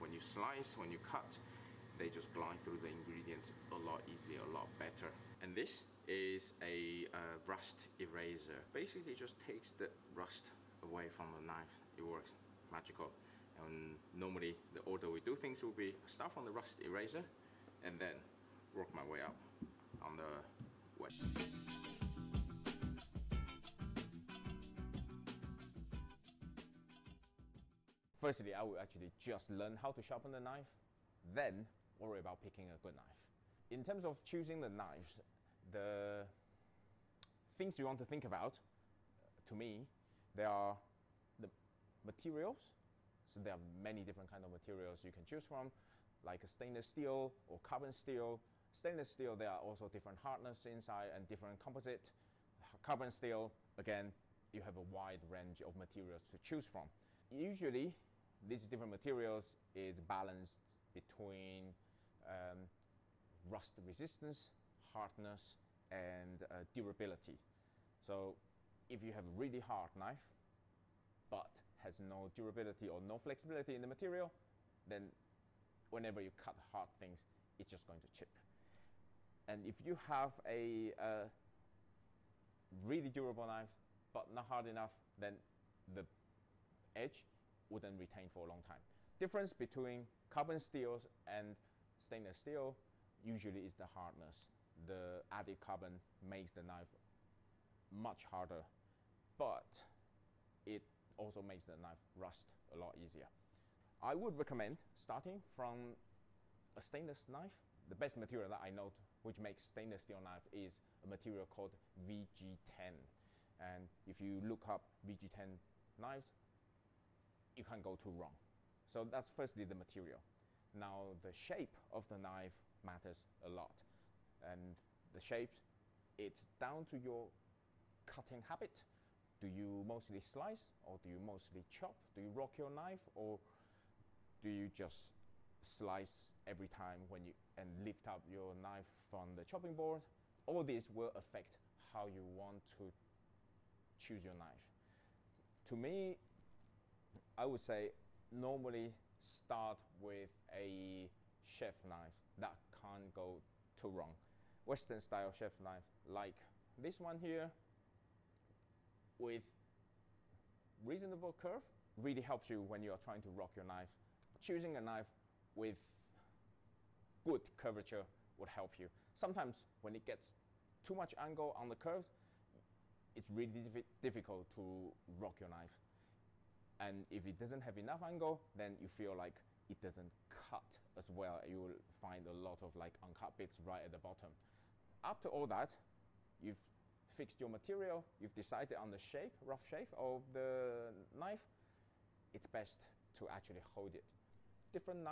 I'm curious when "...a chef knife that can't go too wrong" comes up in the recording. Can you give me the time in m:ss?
2:30.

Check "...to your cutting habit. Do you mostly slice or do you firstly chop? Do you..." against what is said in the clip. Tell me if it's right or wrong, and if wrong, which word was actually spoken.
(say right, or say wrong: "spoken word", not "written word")
wrong: "mostly", not "firstly".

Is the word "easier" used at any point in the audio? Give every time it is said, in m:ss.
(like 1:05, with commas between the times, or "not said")
0:04, 1:42.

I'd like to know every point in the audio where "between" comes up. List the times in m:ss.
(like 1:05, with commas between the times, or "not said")
1:00, 1:29.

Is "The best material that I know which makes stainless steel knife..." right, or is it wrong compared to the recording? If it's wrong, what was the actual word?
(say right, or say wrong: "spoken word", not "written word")
right.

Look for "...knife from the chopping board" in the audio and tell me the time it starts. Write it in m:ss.
2:18.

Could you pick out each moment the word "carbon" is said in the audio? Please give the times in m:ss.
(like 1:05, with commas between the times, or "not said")
0:47, 0:52, 1:30, 1:35.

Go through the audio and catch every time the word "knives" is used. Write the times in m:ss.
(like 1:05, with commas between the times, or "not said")
0:34, 1:55.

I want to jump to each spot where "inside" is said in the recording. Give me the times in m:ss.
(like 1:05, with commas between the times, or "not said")
0:50.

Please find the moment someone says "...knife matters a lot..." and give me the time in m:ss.
2:02.